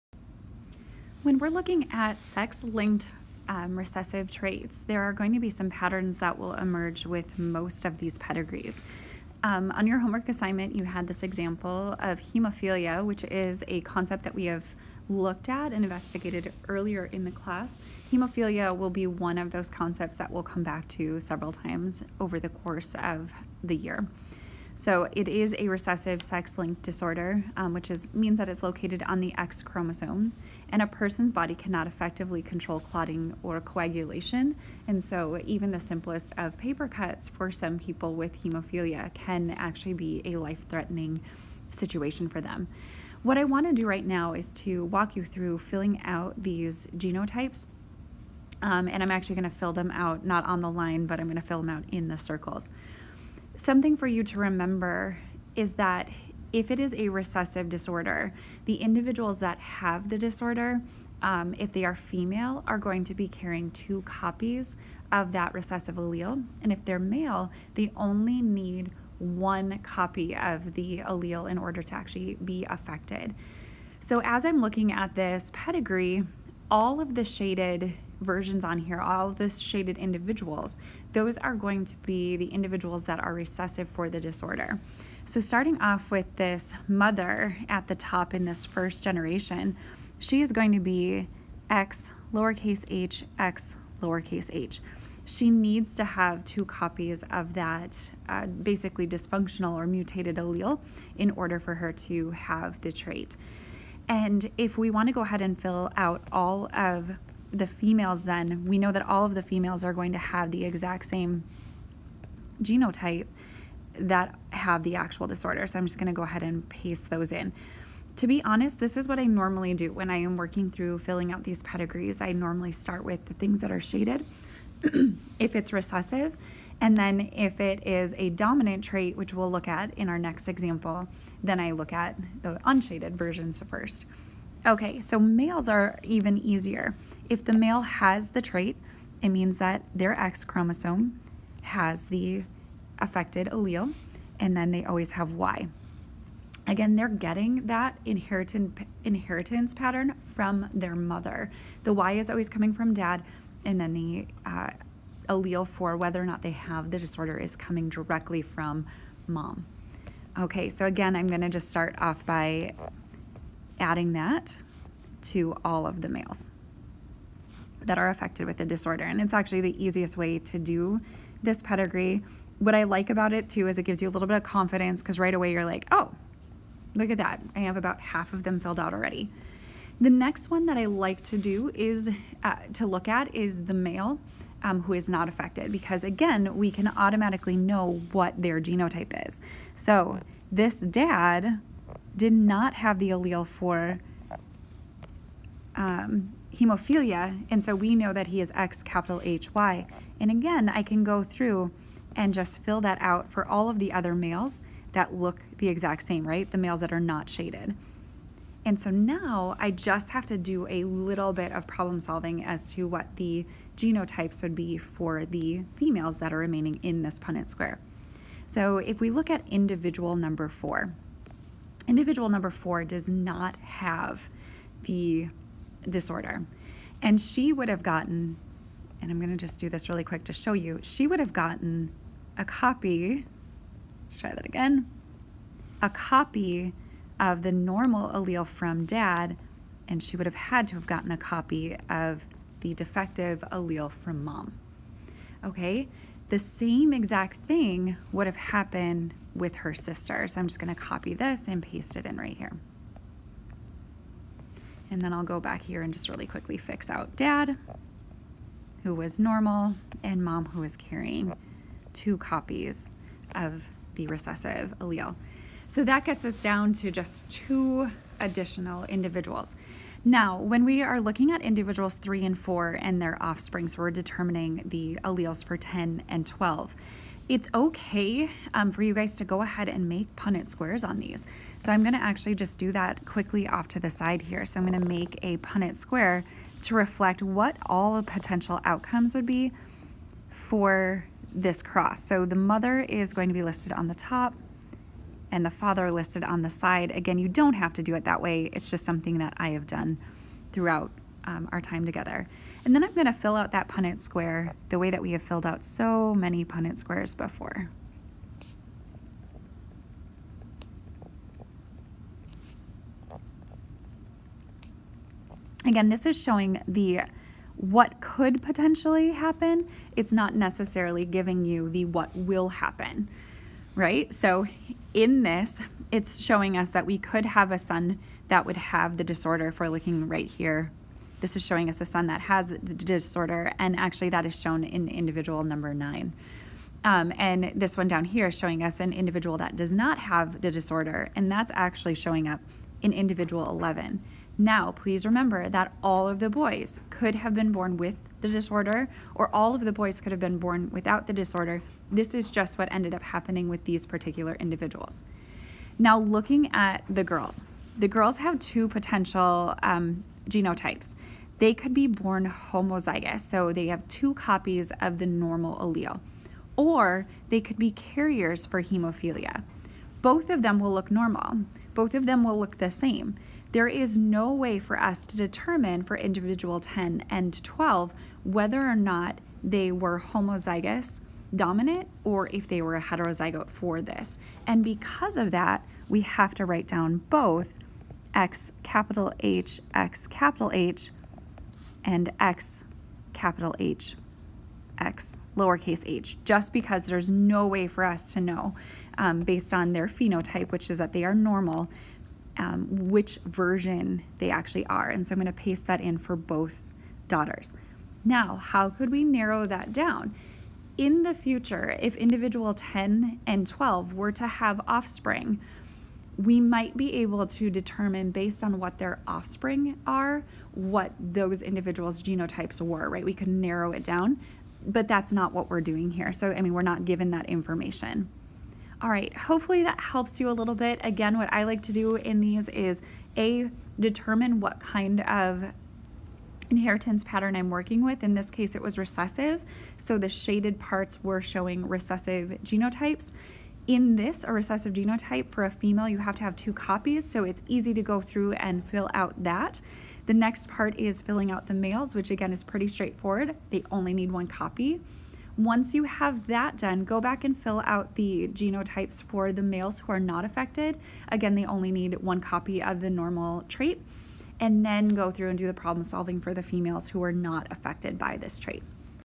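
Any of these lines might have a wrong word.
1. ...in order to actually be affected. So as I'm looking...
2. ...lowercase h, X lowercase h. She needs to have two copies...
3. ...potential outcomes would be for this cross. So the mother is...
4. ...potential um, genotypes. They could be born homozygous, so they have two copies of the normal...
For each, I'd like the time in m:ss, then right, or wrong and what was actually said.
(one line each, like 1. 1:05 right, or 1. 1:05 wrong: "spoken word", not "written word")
1. 1:11 right
2. 1:32 right
3. 4:48 right
4. 5:58 right.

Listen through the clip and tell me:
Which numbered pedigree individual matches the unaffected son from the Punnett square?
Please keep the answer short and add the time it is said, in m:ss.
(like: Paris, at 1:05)
11, at 5:42.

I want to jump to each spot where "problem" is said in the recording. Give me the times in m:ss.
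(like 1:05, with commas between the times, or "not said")
3:31, 7:45.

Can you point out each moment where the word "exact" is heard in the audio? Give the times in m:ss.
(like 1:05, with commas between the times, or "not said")
1:50, 3:25, 4:06.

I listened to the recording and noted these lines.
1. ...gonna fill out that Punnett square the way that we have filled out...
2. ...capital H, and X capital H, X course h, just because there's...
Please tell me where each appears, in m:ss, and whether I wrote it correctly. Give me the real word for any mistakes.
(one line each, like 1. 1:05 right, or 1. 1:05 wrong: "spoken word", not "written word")
1. 5:02 right
2. 6:30 wrong: "lowercase", not "course".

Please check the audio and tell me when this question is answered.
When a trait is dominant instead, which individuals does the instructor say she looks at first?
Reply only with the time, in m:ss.
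2:12.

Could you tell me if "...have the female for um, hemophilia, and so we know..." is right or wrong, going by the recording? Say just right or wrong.
wrong.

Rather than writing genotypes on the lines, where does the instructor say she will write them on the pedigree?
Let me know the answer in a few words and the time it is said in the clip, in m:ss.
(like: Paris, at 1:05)
In the circles, at 0:51.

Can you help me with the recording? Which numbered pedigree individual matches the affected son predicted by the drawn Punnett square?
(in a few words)
9.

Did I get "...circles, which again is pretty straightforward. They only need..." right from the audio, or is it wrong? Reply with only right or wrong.
wrong.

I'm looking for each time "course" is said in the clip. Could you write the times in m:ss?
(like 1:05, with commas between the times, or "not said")
0:22.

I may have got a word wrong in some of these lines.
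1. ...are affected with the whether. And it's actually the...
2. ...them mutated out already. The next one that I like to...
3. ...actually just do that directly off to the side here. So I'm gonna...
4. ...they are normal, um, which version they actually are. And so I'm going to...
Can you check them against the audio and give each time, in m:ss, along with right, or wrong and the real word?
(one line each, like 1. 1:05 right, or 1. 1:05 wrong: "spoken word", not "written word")
1. 2:47 wrong: "disorder", not "whether"
2. 2:58 wrong: "filled", not "mutated"
3. 4:41 wrong: "quickly", not "directly"
4. 6:40 right.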